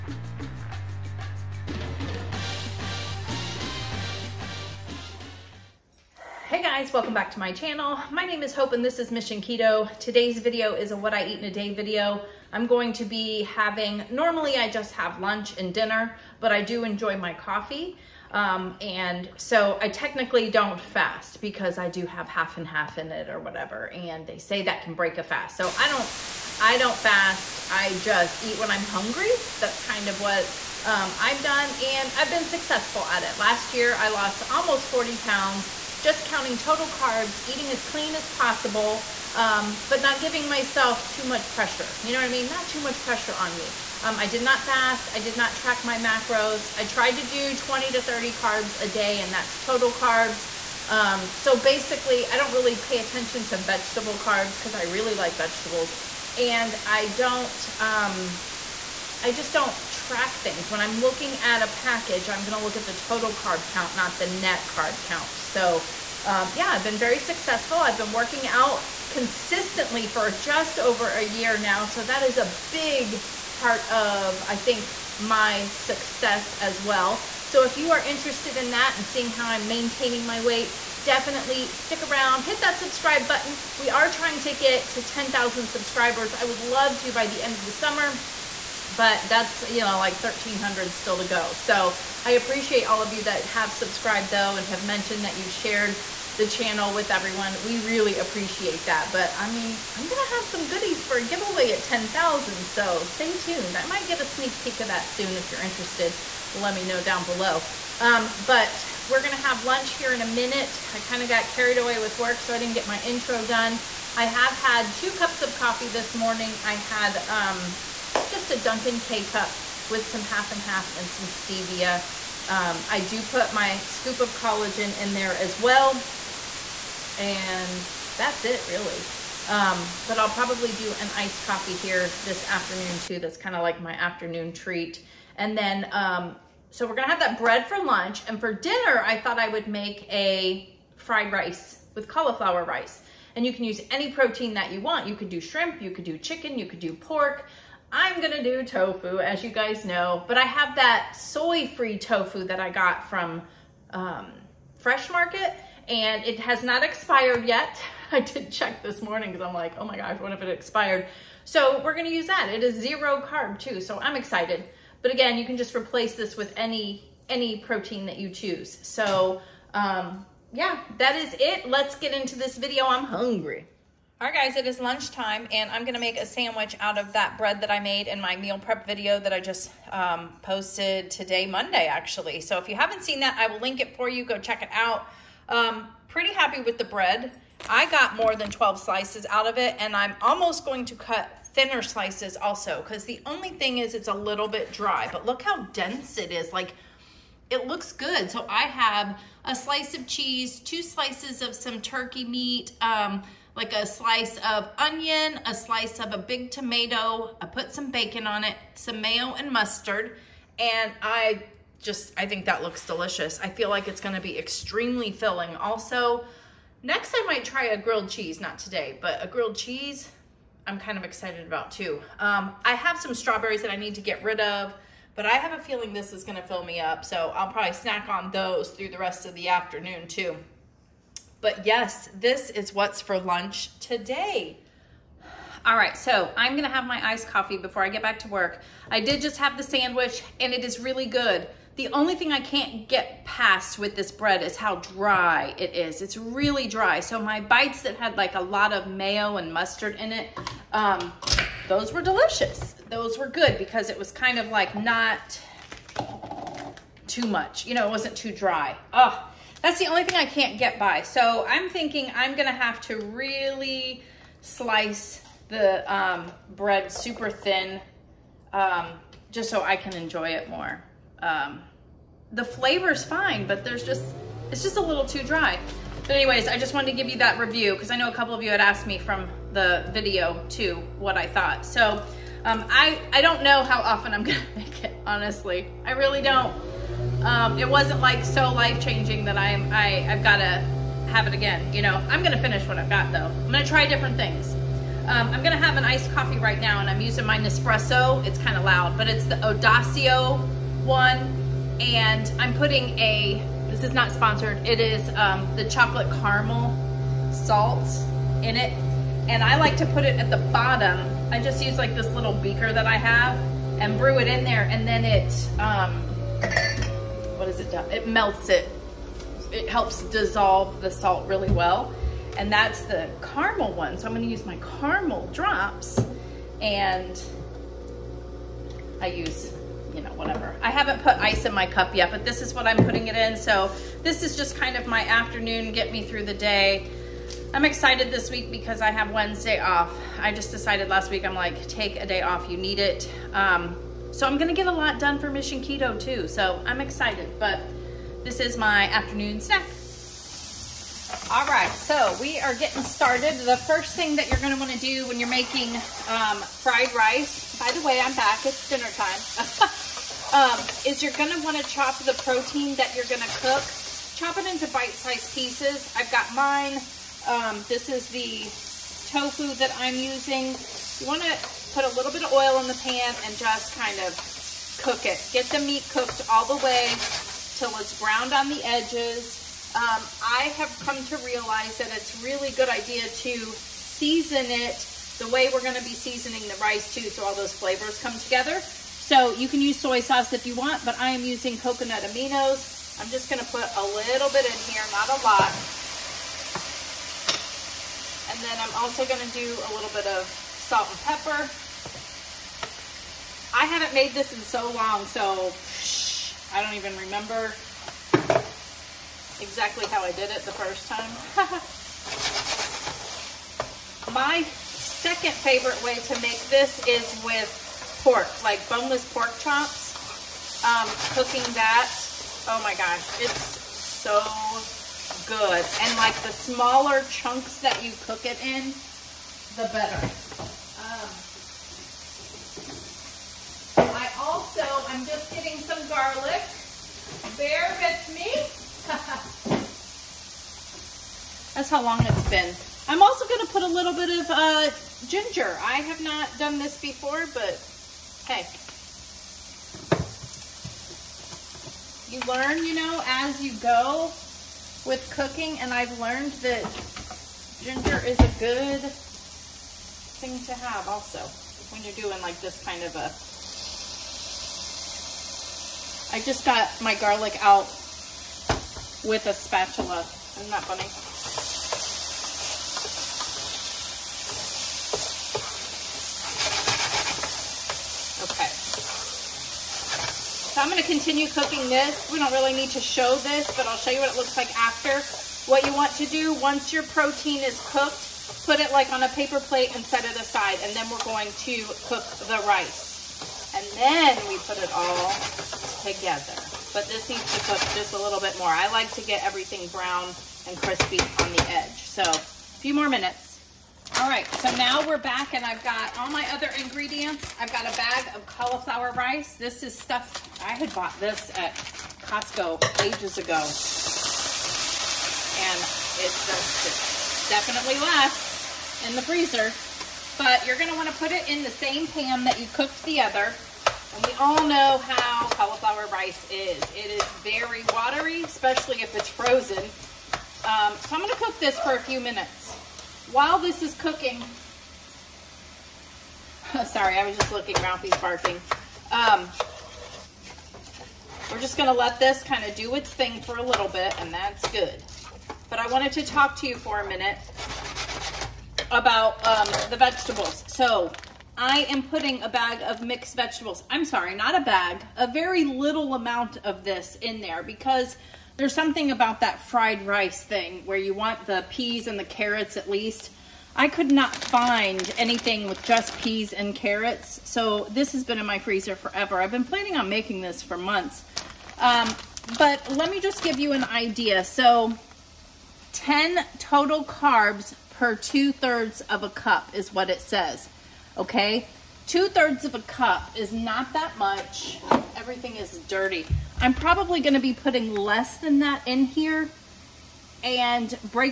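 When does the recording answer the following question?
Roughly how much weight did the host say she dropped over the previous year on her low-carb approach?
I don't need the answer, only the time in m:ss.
0:34.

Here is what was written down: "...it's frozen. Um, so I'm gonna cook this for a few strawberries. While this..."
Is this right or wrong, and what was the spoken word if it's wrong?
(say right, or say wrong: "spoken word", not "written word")
wrong: "minutes", not "strawberries".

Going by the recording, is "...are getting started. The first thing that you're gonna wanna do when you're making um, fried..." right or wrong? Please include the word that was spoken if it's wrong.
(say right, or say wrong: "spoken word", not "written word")
right.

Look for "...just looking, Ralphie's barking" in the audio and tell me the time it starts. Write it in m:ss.
8:57.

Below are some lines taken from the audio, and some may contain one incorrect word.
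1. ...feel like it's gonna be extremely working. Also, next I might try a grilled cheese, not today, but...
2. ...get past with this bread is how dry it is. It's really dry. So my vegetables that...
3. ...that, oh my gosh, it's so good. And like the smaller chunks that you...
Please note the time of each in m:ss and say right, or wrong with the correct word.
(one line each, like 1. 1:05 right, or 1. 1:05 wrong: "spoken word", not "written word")
1. 3:33 wrong: "filling", not "working"
2. 4:02 wrong: "bites", not "vegetables"
3. 7:01 right.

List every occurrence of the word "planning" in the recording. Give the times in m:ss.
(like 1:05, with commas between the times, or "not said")
9:29.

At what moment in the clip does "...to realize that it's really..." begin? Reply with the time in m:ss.
6:21.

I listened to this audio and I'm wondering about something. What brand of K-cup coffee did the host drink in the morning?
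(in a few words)
Dunkin'.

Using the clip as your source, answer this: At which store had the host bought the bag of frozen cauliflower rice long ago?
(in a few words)
Costco.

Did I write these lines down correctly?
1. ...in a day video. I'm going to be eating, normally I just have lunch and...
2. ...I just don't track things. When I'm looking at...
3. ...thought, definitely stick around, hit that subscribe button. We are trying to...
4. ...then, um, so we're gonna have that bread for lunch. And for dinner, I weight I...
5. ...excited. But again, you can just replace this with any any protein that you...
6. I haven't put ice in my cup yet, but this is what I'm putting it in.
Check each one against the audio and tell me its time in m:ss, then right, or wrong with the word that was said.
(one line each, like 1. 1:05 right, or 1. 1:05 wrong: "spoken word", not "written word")
1. 0:11 wrong: "having", not "eating"
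2. 0:59 right
3. 1:20 wrong: "weight", not "thought"
4. 2:15 wrong: "thought", not "weight"
5. 2:44 right
6. 5:30 right.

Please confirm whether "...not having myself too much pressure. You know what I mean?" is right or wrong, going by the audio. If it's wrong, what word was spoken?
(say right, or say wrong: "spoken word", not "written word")
wrong: "giving", not "having".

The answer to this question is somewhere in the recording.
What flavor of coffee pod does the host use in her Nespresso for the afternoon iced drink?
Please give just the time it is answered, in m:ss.
5:05.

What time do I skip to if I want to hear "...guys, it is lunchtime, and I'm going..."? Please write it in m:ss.
2:54.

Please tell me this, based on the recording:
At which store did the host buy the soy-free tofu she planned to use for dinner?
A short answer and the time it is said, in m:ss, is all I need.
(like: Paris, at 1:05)
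Fresh Market, at 2:34.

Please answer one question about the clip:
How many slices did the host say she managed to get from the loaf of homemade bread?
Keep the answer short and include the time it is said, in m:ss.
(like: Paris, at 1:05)
more than 12, at 3:08.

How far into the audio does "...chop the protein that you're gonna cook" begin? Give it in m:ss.
6:01.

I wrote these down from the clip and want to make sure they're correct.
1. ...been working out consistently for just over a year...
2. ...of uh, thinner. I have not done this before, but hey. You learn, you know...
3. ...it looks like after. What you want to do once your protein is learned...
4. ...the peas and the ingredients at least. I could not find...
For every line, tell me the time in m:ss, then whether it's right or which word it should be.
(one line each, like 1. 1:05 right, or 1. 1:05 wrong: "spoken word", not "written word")
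1. 1:07 right
2. 7:24 wrong: "ginger", not "thinner"
3. 8:04 wrong: "cooked", not "learned"
4. 9:21 wrong: "carrots", not "ingredients".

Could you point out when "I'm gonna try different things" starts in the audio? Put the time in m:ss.
4:53.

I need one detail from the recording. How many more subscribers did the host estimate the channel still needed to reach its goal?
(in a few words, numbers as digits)
1300.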